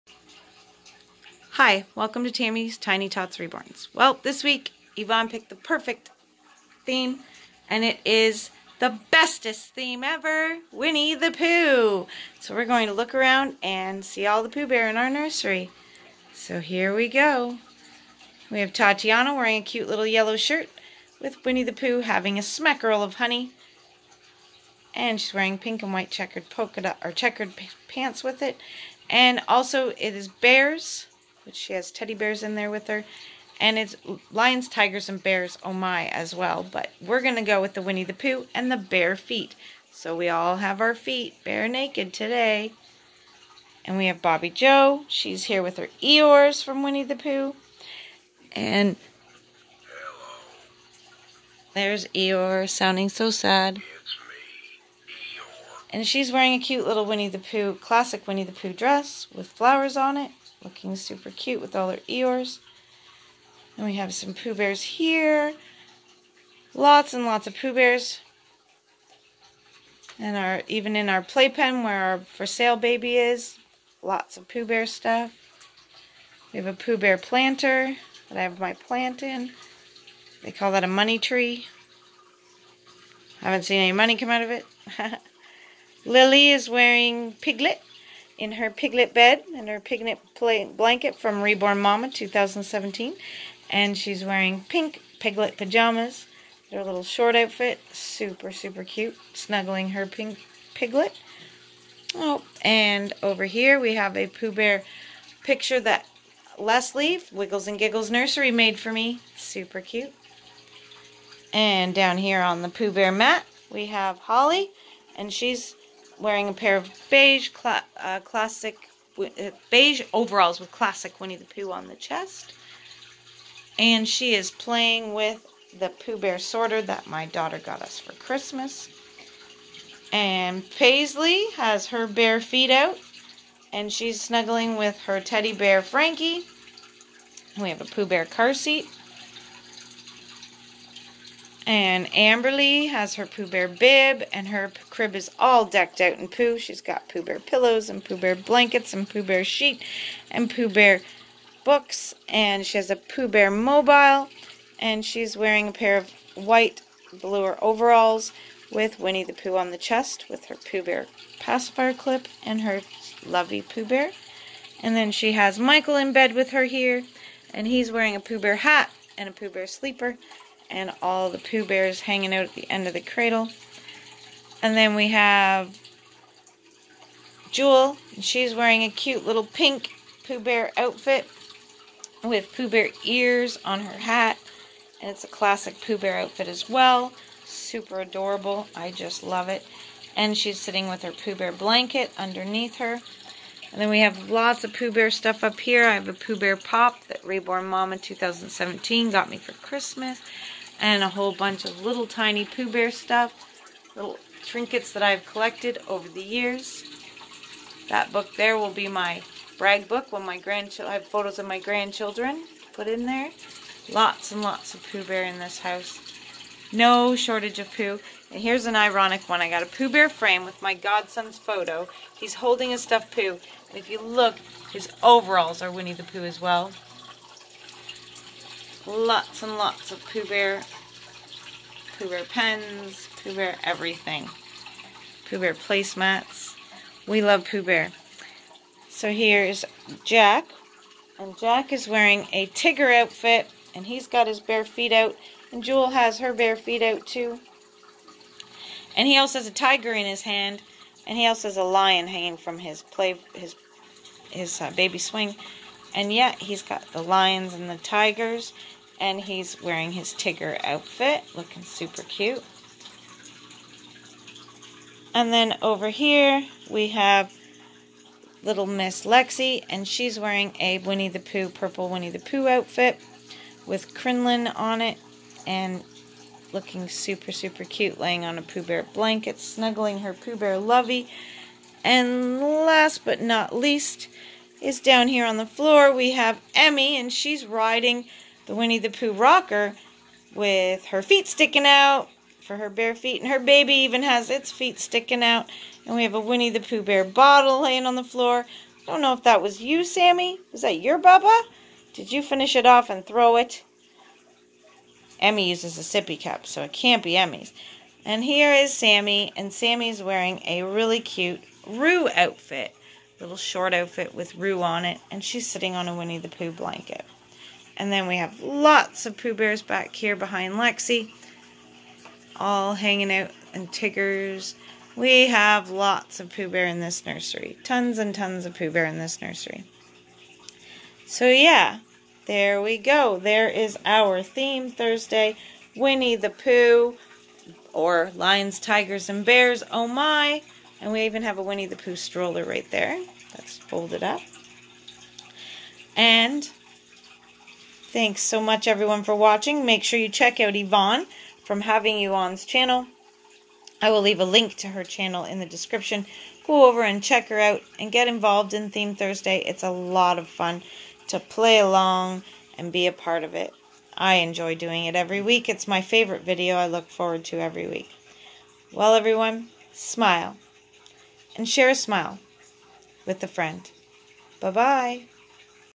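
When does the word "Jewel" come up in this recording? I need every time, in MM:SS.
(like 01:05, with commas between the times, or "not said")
02:57, 04:05.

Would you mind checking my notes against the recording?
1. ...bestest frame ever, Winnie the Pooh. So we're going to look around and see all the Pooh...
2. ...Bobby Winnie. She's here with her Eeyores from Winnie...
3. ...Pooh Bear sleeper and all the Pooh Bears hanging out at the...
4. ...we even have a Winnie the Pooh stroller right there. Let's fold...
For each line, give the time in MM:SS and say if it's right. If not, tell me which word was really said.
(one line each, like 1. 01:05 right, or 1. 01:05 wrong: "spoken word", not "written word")
1. 00:09 wrong: "theme", not "frame"
2. 00:44 wrong: "Joe", not "Winnie"
3. 02:49 right
4. 05:40 right.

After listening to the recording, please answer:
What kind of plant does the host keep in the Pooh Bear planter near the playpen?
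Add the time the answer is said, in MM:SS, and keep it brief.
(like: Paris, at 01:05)
Money tree, at 01:20.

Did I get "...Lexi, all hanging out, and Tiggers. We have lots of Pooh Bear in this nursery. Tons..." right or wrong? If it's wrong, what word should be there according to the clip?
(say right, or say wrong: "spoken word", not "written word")
right.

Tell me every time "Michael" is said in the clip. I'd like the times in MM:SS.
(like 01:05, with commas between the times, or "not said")
02:45.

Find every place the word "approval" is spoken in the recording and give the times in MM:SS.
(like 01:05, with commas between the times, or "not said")
not said.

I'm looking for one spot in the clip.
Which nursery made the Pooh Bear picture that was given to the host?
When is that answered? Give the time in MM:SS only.
01:47.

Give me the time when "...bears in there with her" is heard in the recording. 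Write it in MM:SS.
00:32.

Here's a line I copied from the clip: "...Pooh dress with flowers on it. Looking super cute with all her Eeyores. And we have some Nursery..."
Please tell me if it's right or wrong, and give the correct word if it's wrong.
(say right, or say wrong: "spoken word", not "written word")
wrong: "Pooh", not "Nursery".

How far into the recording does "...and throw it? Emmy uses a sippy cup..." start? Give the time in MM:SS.
05:02.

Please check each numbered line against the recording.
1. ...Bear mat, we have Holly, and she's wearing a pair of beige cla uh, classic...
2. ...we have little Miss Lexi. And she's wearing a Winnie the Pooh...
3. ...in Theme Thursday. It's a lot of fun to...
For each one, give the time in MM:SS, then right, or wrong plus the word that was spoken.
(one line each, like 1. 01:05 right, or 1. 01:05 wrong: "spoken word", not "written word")
1. 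01:52 right
2. 04:26 right
3. 05:58 right.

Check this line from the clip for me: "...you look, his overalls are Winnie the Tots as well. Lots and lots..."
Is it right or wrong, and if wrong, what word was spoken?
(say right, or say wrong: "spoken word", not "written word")
wrong: "Pooh", not "Tots".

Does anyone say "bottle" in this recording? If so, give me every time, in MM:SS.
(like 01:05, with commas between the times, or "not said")
04:57.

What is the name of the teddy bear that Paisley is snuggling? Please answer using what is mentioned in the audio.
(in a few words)
Frankie.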